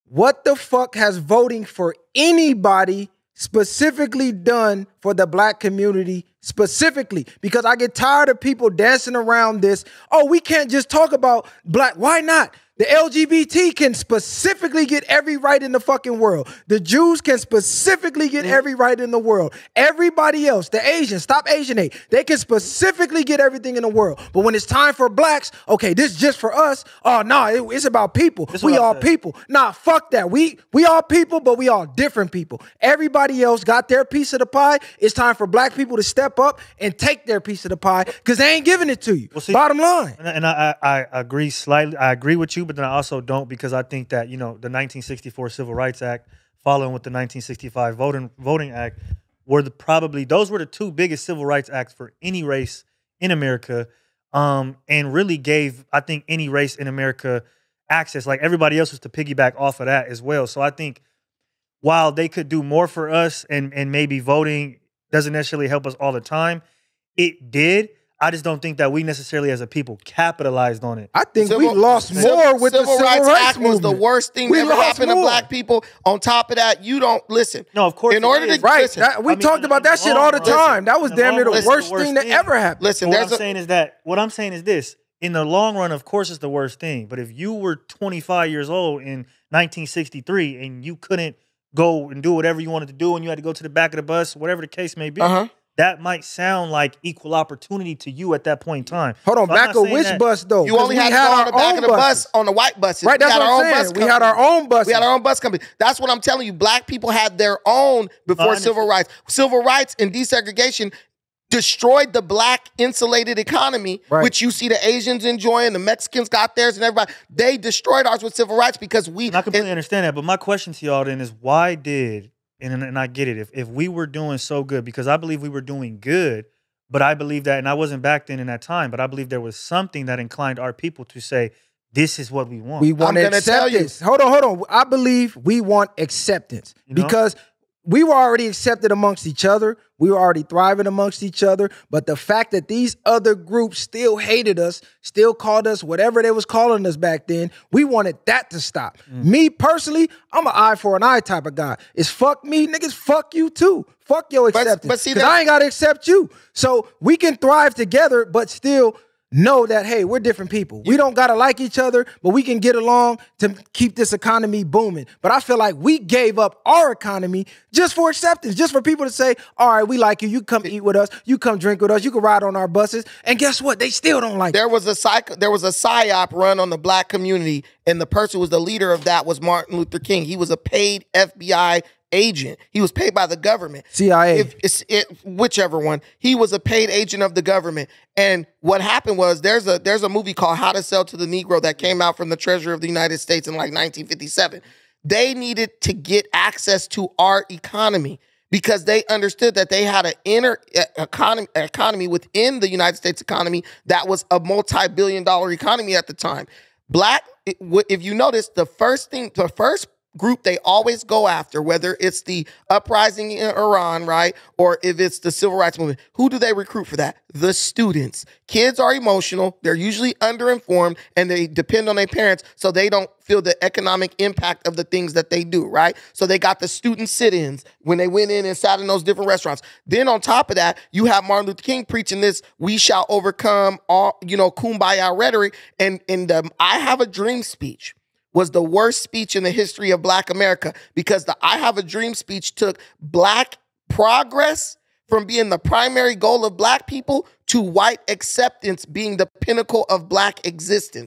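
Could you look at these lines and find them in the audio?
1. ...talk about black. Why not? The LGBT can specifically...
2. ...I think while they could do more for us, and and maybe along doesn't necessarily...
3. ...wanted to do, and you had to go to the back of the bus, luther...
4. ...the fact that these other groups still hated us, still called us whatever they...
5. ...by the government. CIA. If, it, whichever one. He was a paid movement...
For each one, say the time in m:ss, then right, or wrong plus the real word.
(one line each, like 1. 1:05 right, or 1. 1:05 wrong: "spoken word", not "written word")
1. 0:10 right
2. 1:00 wrong: "voting", not "along"
3. 1:32 wrong: "whatever", not "luther"
4. 2:22 right
5. 3:03 wrong: "agent", not "movement".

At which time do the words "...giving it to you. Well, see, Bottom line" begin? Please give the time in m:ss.
0:38.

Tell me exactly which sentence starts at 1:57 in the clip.
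They destroyed ours with civil rights because we.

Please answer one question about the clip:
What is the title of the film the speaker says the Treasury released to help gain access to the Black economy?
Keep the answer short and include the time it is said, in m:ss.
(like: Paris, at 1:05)
How to Sell to the Negro, at 3:10.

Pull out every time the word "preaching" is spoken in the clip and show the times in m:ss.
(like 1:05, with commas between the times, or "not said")
3:51.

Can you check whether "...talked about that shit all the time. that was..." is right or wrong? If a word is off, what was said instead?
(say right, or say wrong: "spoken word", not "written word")
right.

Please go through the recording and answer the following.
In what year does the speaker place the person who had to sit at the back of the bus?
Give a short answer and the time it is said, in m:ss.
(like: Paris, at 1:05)
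1963, at 1:29.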